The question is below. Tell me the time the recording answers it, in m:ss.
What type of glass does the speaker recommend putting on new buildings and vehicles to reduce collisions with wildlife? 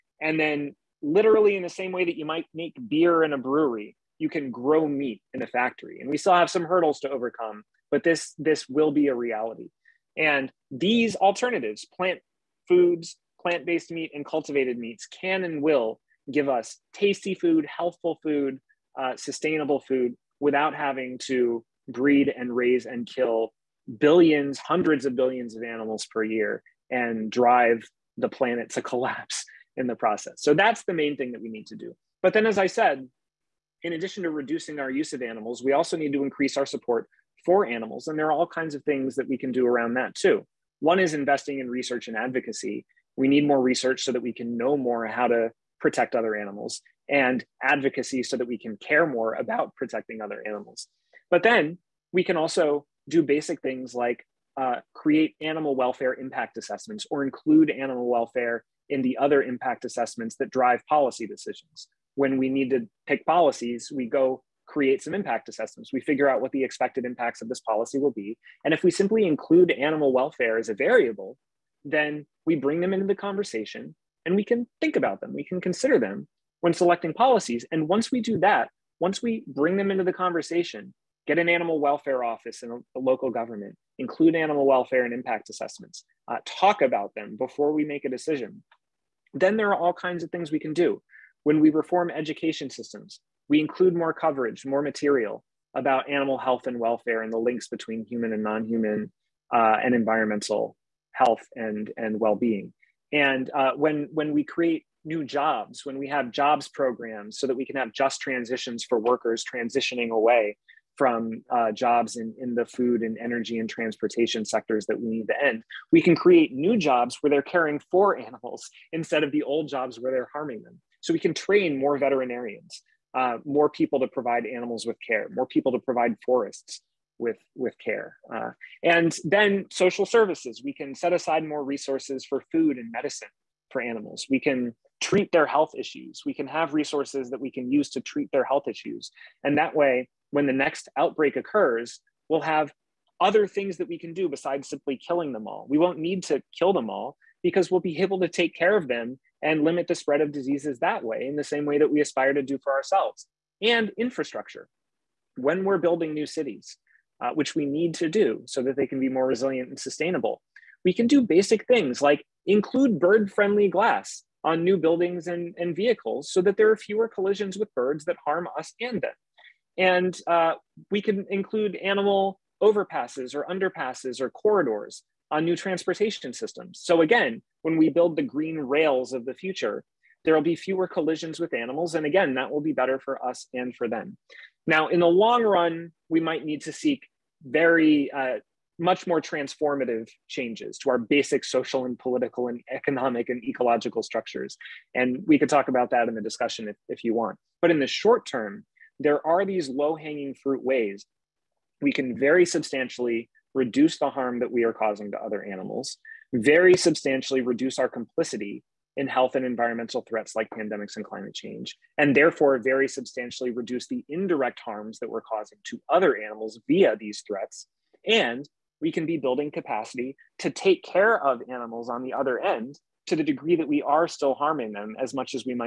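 2:42.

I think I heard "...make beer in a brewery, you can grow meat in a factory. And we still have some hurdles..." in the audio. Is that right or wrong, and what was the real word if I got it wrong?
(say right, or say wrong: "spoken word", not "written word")
right.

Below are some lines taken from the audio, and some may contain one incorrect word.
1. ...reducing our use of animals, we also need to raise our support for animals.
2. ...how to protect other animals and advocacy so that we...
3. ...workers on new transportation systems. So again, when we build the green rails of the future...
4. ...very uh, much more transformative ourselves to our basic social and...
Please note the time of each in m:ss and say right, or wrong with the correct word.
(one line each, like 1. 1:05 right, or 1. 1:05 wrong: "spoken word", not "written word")
1. 0:34 wrong: "increase", not "raise"
2. 0:45 right
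3. 2:54 wrong: "corridors", not "workers"
4. 3:07 wrong: "changes", not "ourselves".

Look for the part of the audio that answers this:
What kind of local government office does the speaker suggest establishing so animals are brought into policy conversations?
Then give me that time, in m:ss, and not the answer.
1:21.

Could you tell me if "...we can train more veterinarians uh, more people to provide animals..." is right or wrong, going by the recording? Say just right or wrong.
right.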